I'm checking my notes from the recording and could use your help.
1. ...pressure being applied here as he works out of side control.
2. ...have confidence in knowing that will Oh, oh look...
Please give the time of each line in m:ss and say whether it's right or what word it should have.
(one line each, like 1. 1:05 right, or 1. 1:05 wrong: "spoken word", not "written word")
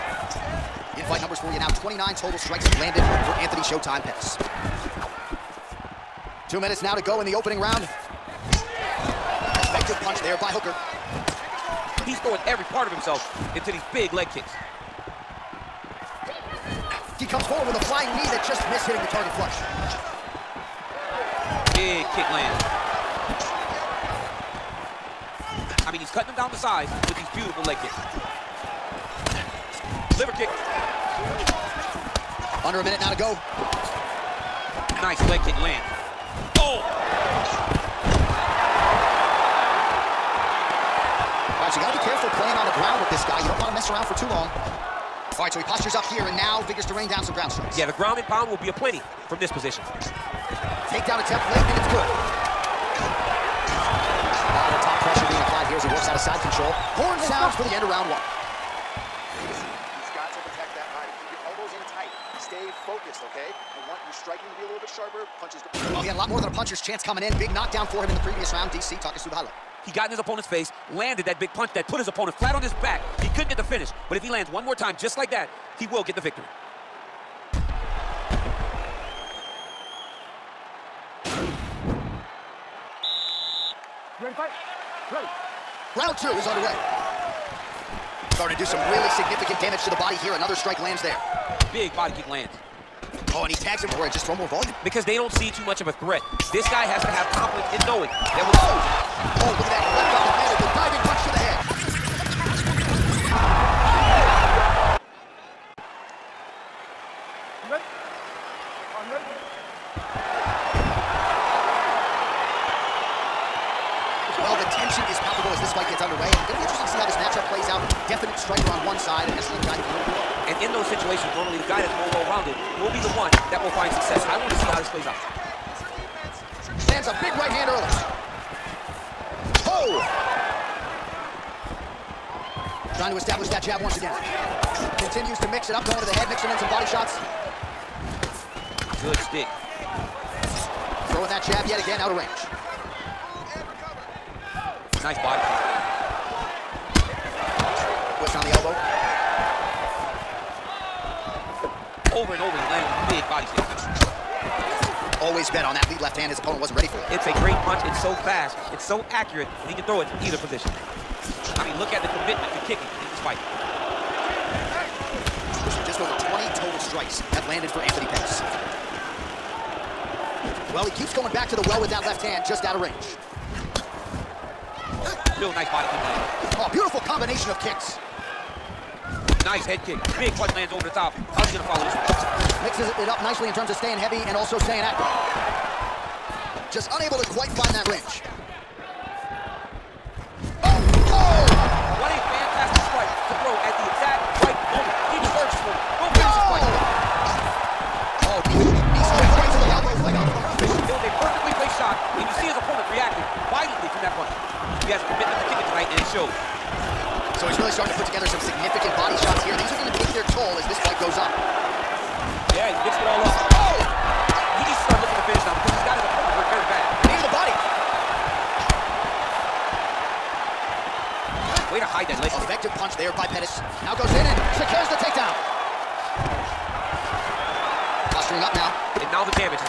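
1. 0:55 right
2. 1:37 right.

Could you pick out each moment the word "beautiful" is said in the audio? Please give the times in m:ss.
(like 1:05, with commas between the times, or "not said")
0:27, 2:56.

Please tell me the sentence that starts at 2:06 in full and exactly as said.
Lands a big right hand early.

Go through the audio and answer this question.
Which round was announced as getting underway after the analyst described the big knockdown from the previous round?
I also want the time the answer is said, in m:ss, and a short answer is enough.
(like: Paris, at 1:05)
Round two, at 1:25.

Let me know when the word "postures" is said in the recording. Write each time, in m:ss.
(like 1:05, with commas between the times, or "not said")
0:45.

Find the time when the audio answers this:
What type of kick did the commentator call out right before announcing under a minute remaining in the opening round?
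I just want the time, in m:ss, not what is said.
0:30.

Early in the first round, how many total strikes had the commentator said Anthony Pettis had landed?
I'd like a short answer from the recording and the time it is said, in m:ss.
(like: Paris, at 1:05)
29, at 0:01.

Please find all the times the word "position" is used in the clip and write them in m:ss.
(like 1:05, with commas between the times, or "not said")
0:49, 2:40.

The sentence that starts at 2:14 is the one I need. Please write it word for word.
Continues to mix it up, going to the head, mixing in some body shots.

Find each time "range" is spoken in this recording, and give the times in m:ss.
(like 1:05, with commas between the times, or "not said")
2:22, 2:52, 3:07.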